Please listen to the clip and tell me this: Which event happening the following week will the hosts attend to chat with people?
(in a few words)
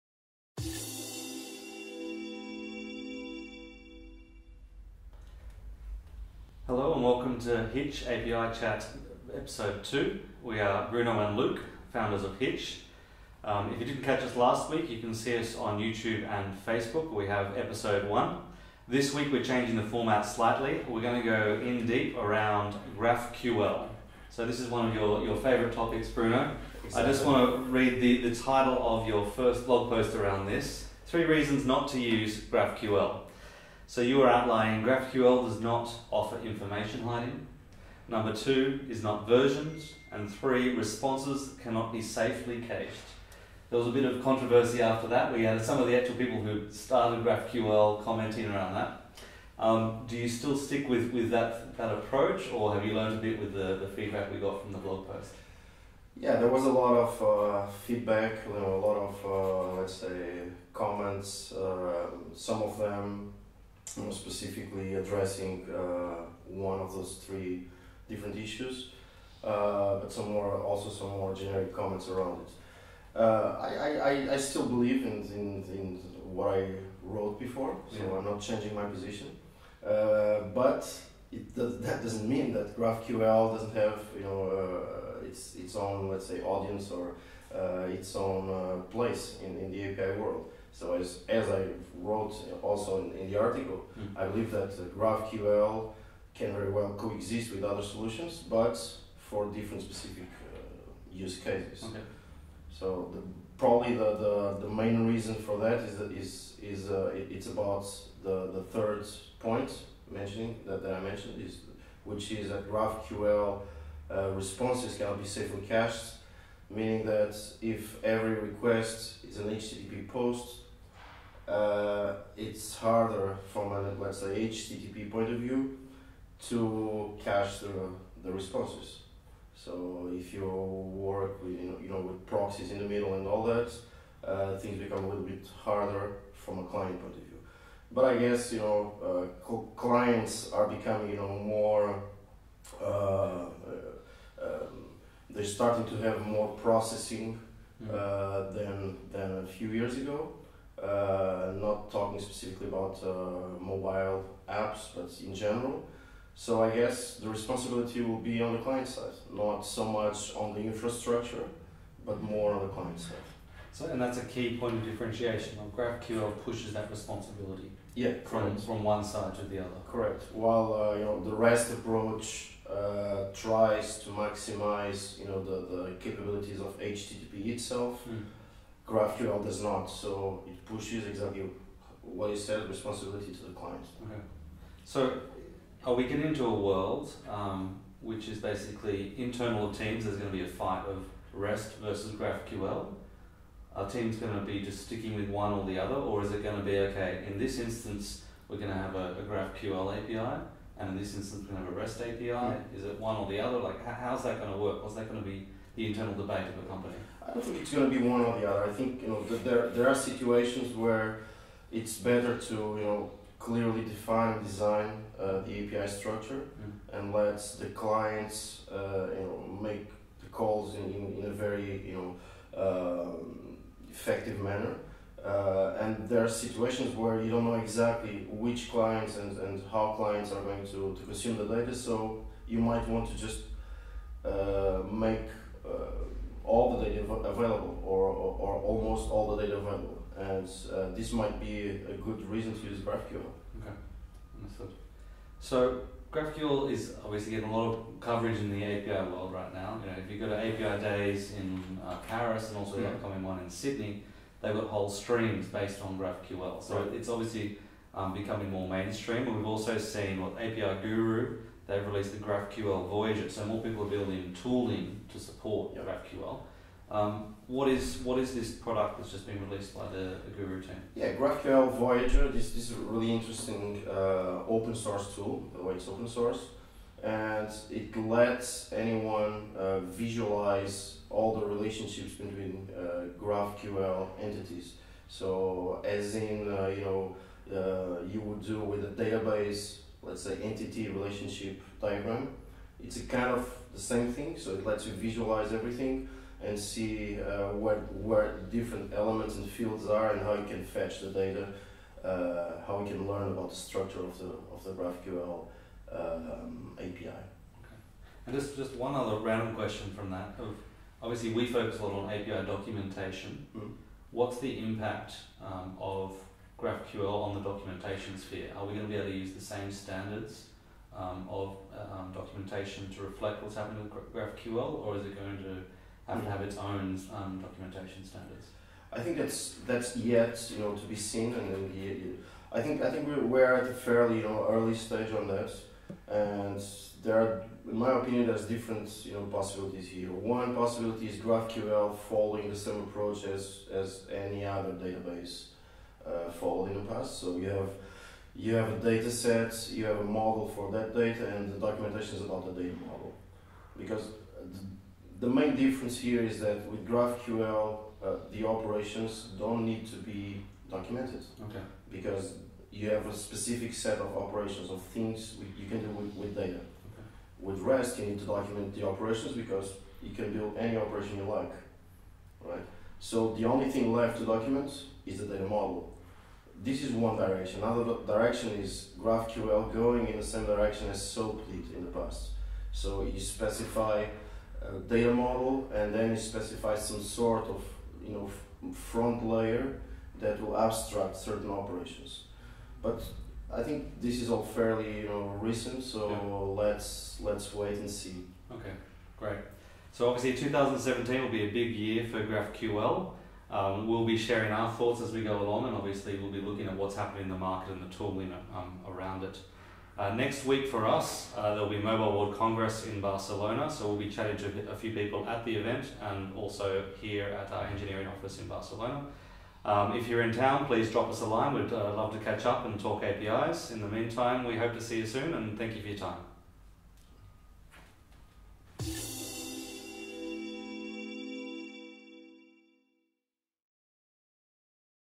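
Mobile World Congress.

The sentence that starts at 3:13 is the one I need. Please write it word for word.
Our team's going to be just sticking with one or the other, or is it going to be okay?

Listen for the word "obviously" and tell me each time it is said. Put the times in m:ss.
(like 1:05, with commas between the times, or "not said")
4:07, 4:17, 5:11, 6:40, 6:45.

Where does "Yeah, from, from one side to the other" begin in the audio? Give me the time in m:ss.
2:47.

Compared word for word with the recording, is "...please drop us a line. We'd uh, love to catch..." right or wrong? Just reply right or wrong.
right.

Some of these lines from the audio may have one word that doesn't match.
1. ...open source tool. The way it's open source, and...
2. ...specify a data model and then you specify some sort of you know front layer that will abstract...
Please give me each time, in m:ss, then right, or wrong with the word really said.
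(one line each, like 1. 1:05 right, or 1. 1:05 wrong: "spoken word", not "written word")
1. 4:34 right
2. 6:23 right.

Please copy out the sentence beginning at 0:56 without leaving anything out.
Yeah, there was a lot of uh, feedback, you know, a lot of, uh, let's say, comments.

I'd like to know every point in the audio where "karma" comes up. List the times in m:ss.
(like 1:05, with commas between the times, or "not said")
not said.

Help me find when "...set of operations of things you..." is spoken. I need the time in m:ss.
6:03.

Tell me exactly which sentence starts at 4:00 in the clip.
And uh, this might be a good reason to use GraphQL.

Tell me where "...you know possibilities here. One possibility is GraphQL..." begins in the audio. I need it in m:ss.
5:39.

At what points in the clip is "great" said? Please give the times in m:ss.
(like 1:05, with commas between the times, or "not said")
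6:39.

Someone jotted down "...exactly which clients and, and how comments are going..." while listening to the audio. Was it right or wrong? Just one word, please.
wrong.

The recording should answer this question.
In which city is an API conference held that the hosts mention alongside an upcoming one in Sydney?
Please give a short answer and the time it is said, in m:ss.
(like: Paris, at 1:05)
Paris, at 4:12.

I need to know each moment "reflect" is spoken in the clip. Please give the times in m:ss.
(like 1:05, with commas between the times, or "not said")
5:23.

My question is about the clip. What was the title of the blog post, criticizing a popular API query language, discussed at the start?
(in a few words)
Three reasons not to use GraphQL.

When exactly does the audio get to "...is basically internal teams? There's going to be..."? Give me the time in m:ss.
3:08.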